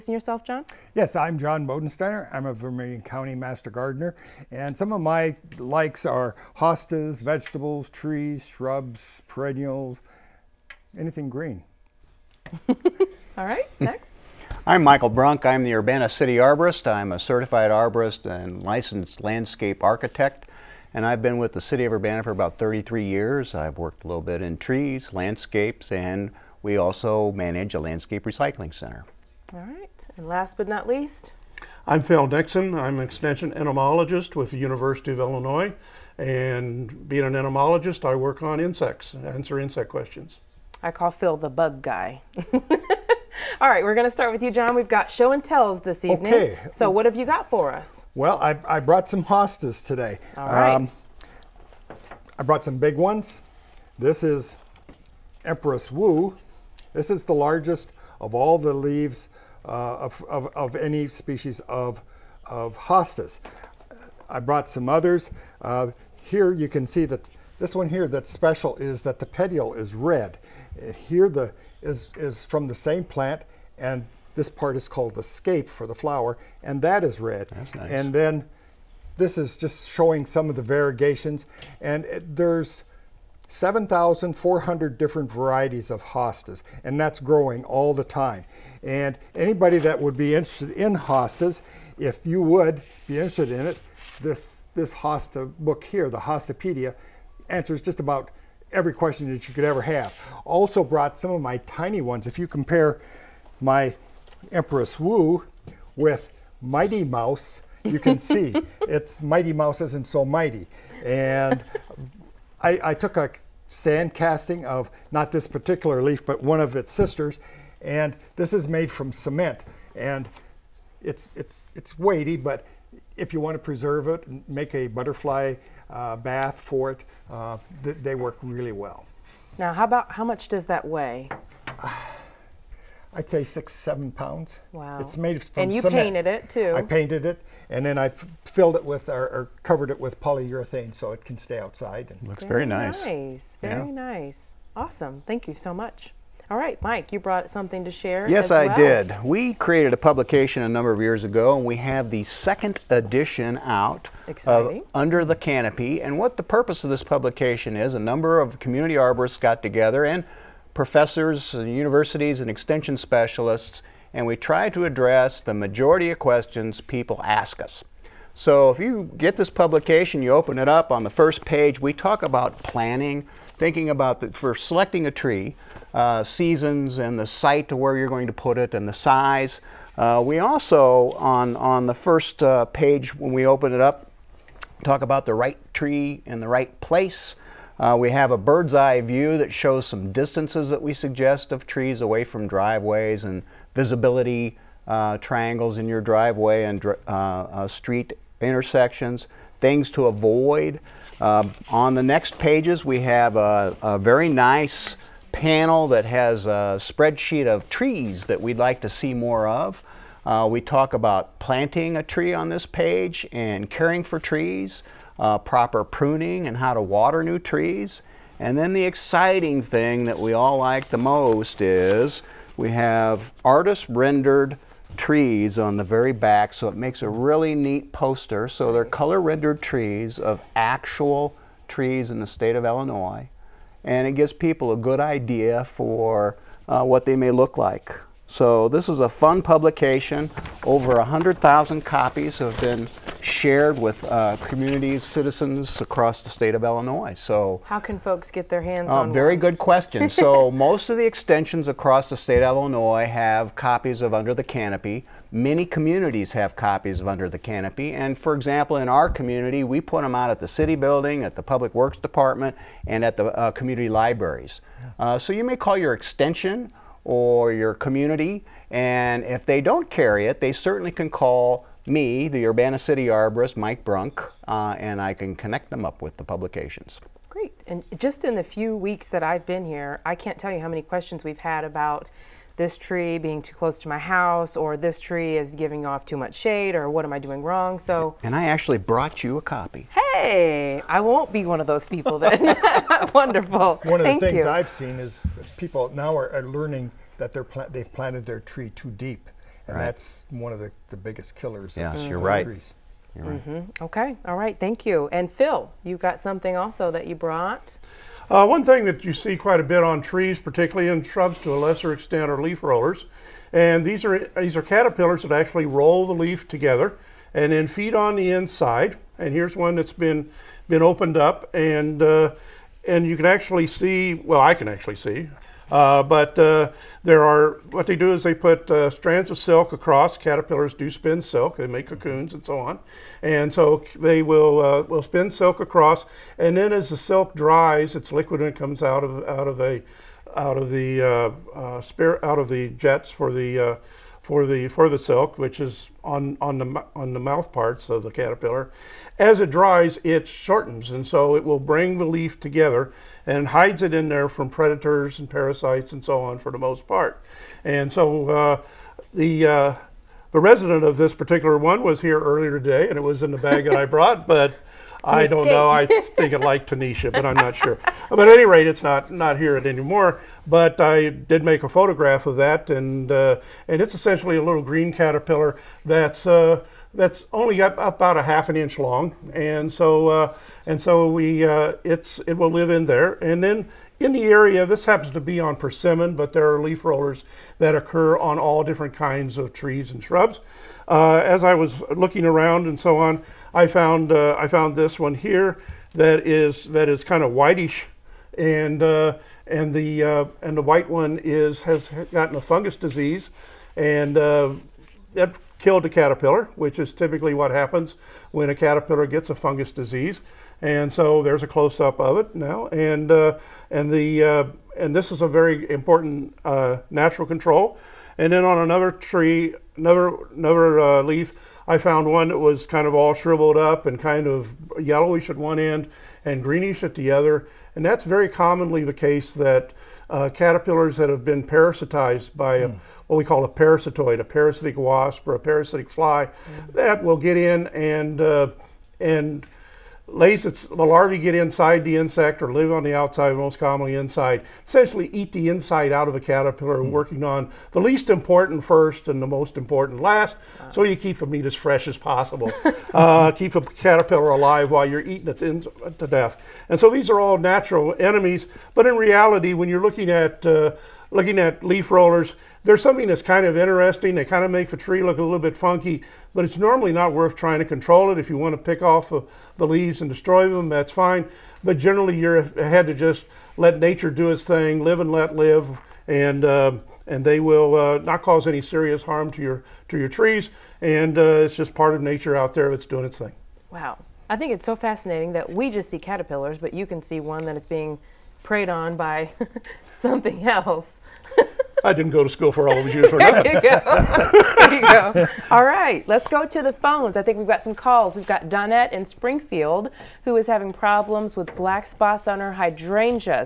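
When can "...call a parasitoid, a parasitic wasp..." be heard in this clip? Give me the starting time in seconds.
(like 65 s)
433 s.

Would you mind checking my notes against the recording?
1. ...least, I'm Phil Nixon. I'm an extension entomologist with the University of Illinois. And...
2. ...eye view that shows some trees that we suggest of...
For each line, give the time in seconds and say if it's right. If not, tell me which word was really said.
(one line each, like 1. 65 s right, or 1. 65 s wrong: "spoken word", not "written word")
1. 30 s right
2. 188 s wrong: "distances", not "trees".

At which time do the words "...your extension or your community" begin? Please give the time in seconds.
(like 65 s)
265 s.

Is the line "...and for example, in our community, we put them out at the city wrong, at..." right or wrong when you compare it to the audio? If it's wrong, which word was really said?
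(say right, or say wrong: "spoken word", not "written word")
wrong: "building", not "wrong".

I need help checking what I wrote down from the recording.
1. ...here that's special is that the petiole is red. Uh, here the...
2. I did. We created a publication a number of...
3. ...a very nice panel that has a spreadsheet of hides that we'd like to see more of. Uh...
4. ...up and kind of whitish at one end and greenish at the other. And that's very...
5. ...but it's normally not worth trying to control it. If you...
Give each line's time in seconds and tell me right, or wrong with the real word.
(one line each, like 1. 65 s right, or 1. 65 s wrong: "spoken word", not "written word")
1. 67 s right
2. 148 s right
3. 203 s wrong: "trees", not "hides"
4. 423 s wrong: "yellowish", not "whitish"
5. 466 s right.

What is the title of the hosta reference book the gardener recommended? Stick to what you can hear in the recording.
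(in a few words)
Hostapedia.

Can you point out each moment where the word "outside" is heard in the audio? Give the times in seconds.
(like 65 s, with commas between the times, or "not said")
141 s, 442 s.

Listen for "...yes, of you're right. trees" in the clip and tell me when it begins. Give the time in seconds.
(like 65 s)
301 s.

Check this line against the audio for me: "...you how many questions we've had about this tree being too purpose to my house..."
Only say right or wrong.
wrong.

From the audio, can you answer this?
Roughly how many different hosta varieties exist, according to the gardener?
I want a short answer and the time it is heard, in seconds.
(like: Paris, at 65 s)
7,400, at 83 s.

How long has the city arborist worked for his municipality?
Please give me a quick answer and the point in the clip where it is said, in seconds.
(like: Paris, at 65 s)
33 years, at 22 s.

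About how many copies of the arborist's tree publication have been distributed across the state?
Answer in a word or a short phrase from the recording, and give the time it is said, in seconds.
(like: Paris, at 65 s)
Over 100,000, at 240 s.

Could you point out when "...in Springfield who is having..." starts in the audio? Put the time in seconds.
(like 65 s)
498 s.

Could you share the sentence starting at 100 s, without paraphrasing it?
Also brought some of my tiny ones.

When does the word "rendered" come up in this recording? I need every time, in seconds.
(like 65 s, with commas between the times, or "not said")
223 s, 229 s.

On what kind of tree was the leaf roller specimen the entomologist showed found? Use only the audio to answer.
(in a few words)
Persimmon.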